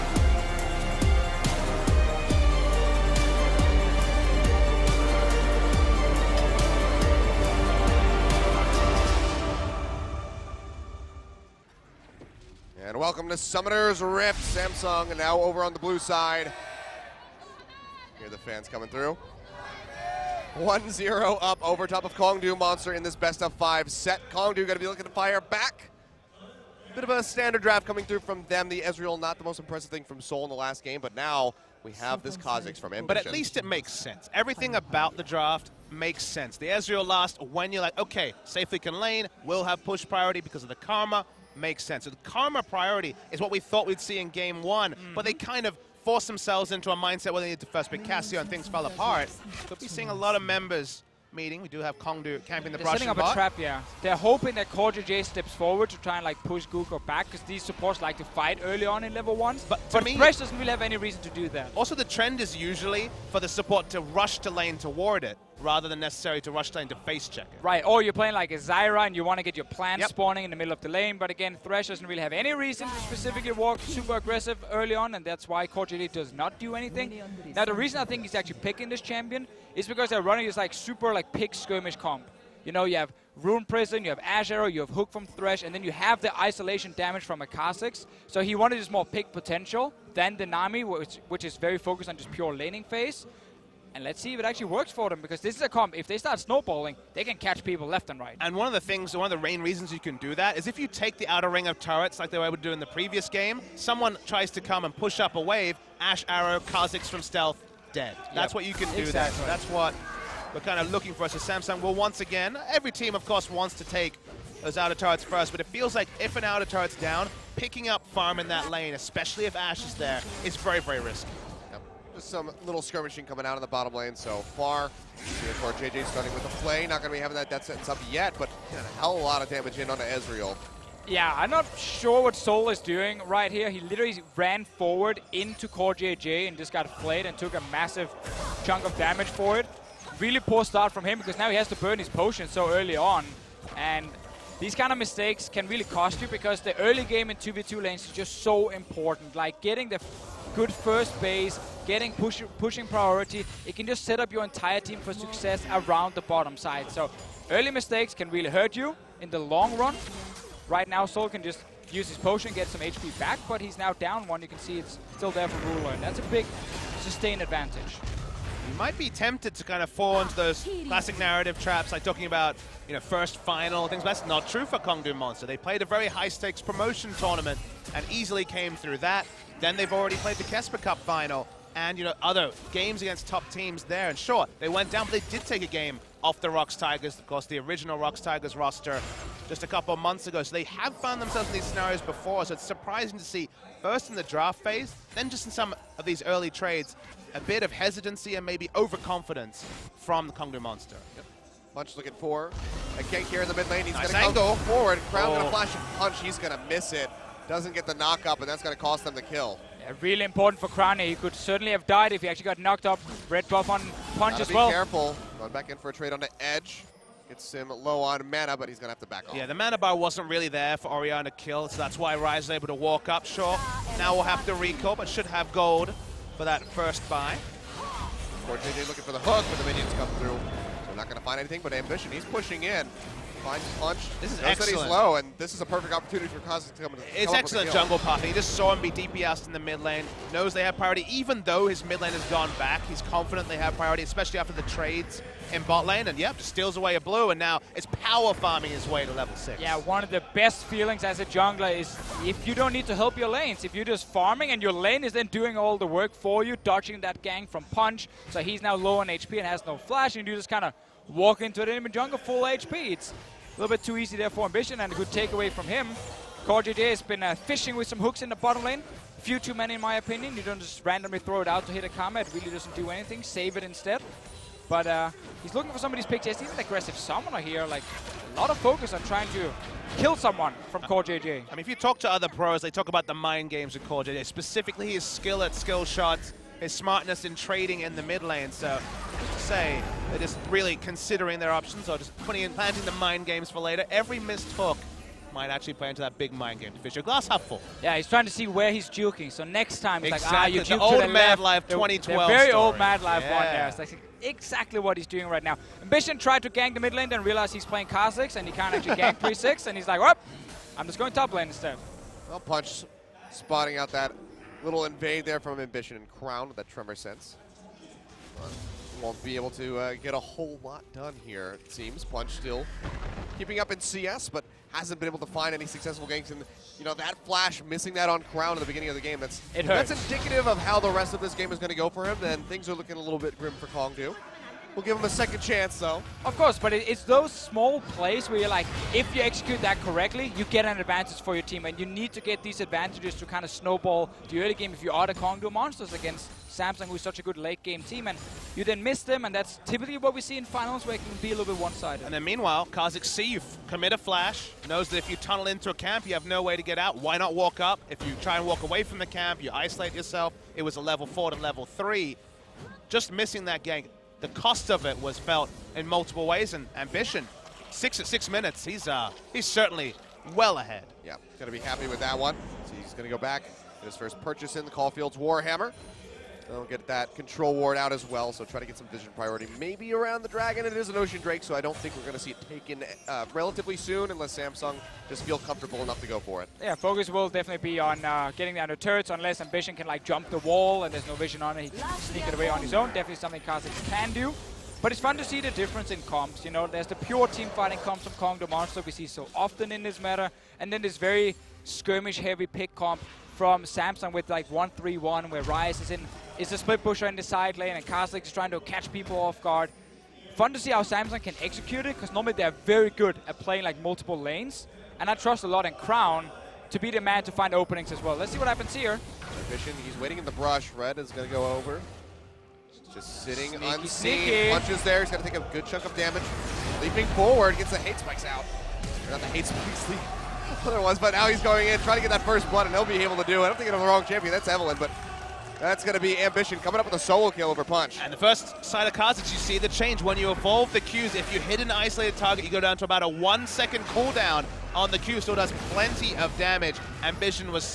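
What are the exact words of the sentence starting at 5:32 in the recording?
Then things are looking a little bit grim for Kongdoo.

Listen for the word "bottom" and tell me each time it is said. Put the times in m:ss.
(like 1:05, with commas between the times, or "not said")
2:03, 2:36, 4:28.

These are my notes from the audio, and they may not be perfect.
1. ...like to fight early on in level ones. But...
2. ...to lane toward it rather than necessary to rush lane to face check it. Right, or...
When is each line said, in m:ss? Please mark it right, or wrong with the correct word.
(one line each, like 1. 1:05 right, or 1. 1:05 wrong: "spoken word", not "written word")
1. 0:57 right
2. 1:04 right.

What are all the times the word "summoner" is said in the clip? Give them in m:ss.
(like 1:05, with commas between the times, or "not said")
0:13, 4:36.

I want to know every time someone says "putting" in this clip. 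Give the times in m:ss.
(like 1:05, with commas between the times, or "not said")
4:52.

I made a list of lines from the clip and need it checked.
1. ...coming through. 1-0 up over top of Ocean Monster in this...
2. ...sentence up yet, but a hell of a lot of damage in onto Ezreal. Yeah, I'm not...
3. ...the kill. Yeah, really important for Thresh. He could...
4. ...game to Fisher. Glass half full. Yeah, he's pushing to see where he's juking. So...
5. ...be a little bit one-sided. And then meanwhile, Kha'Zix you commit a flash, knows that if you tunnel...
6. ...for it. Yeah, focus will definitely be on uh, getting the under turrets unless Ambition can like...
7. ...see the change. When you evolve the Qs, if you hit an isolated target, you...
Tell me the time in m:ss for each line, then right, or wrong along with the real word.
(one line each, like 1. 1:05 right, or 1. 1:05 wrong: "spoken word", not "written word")
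1. 0:18 wrong: "Kongdoo", not "Ocean"
2. 2:07 right
3. 3:29 wrong: "Krane", not "Thresh"
4. 4:56 wrong: "trying", not "pushing"
5. 5:51 right
6. 6:26 right
7. 7:19 right.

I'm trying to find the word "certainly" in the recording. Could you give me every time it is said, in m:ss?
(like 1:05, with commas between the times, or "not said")
3:31, 6:09.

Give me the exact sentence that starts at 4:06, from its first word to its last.
And yep, just steals away a blue, and now it's power farming his way to level six.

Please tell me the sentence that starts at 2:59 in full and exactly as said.
Then they've already played the KeSPA Cup final and, you know, other games against top teams there.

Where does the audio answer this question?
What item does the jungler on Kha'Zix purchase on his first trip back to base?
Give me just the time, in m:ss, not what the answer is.
6:14.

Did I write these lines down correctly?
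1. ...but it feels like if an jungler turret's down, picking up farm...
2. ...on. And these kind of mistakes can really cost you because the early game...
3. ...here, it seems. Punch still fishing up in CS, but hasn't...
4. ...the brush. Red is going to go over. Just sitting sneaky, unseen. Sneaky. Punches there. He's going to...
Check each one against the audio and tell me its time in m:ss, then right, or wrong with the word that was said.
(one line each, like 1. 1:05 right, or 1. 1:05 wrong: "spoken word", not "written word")
1. 1:55 wrong: "outer", not "jungler"
2. 2:22 right
3. 5:21 wrong: "keeping", not "fishing"
4. 7:00 right.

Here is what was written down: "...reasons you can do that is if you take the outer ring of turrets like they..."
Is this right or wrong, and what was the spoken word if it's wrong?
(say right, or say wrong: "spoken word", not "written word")
right.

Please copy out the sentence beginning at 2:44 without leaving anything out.
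You can see it's still there for Ruler, and that's a big sustained advantage.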